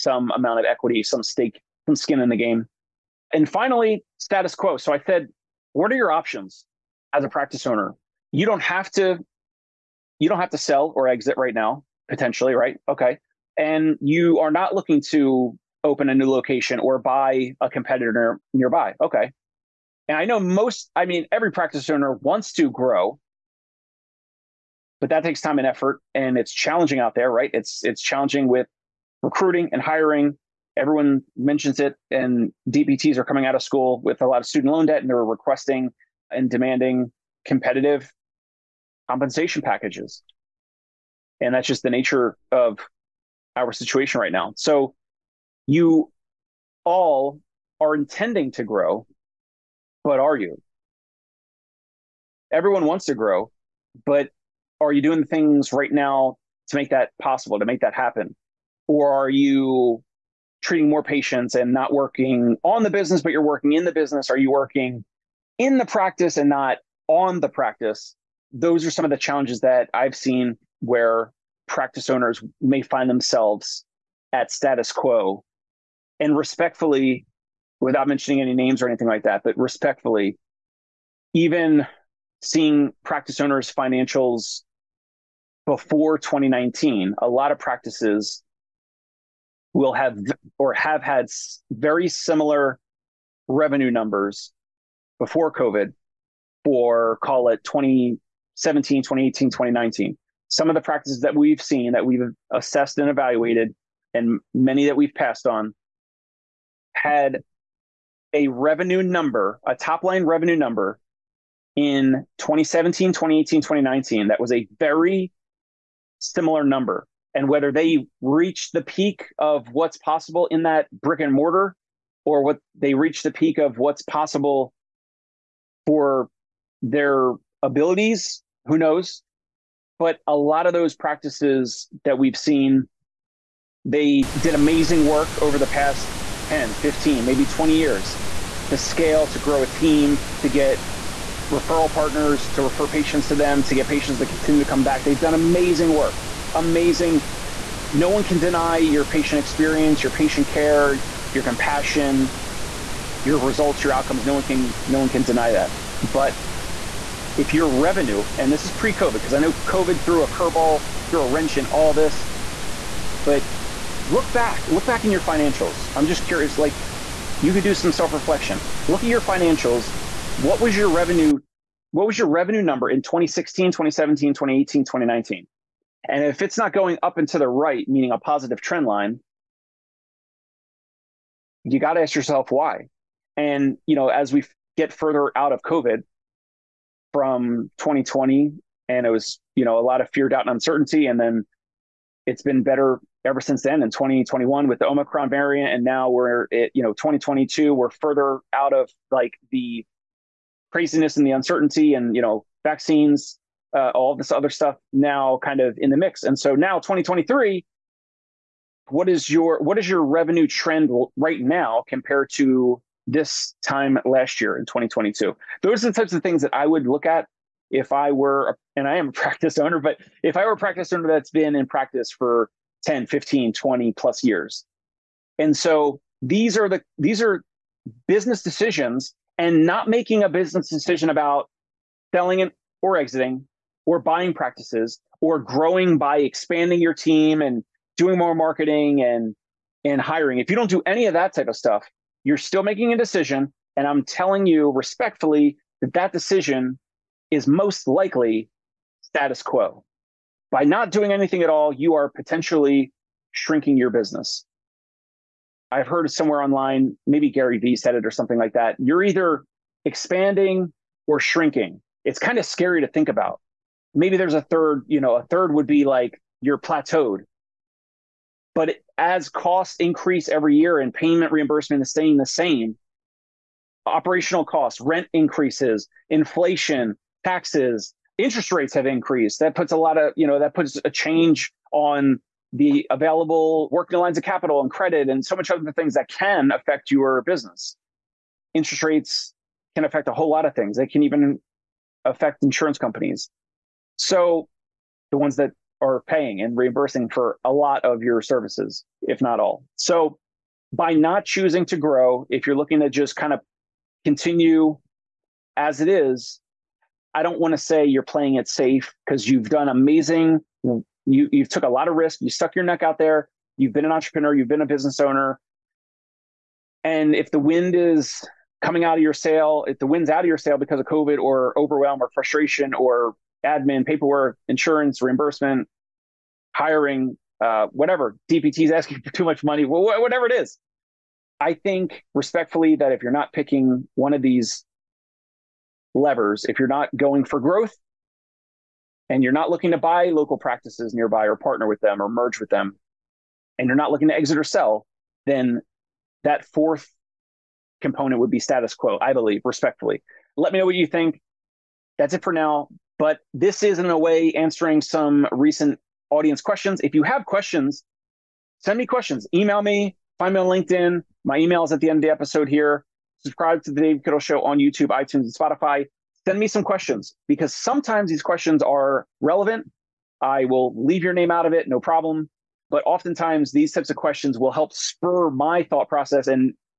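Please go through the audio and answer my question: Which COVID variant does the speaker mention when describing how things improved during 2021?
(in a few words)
omicron.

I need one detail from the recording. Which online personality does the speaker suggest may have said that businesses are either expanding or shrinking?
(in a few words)
Gary Vee.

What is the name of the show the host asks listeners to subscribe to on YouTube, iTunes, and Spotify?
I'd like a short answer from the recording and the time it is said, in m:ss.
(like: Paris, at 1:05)
The Dave Kittle Show, at 6:03.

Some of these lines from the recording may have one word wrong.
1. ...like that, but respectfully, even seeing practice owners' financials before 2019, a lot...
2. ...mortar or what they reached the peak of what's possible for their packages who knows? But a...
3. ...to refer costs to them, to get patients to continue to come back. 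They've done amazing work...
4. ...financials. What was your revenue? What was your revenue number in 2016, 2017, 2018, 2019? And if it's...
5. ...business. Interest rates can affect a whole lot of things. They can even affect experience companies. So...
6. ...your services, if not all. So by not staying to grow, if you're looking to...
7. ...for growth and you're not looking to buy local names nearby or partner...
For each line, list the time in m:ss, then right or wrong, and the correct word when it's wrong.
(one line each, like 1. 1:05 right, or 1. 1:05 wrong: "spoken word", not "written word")
1. 1:19 right
2. 2:01 wrong: "abilities", not "packages"
3. 2:22 wrong: "patients", not "costs"
4. 2:49 right
5. 4:47 wrong: "insurance", not "experience"
6. 4:58 wrong: "choosing", not "staying"
7. 5:37 wrong: "practices", not "names".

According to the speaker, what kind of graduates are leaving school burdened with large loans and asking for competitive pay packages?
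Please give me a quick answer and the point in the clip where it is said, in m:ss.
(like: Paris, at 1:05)
DPTs, at 0:32.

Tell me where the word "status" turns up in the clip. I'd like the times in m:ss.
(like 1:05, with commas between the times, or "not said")
0:04, 1:14, 4:09, 5:48.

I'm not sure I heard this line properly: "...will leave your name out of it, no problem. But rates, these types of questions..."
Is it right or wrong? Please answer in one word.
wrong.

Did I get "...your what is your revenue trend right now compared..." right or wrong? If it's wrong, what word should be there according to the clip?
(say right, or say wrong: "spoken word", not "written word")
right.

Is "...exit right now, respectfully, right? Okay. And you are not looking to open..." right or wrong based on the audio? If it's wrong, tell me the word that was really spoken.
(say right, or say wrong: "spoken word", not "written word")
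wrong: "potentially", not "respectfully".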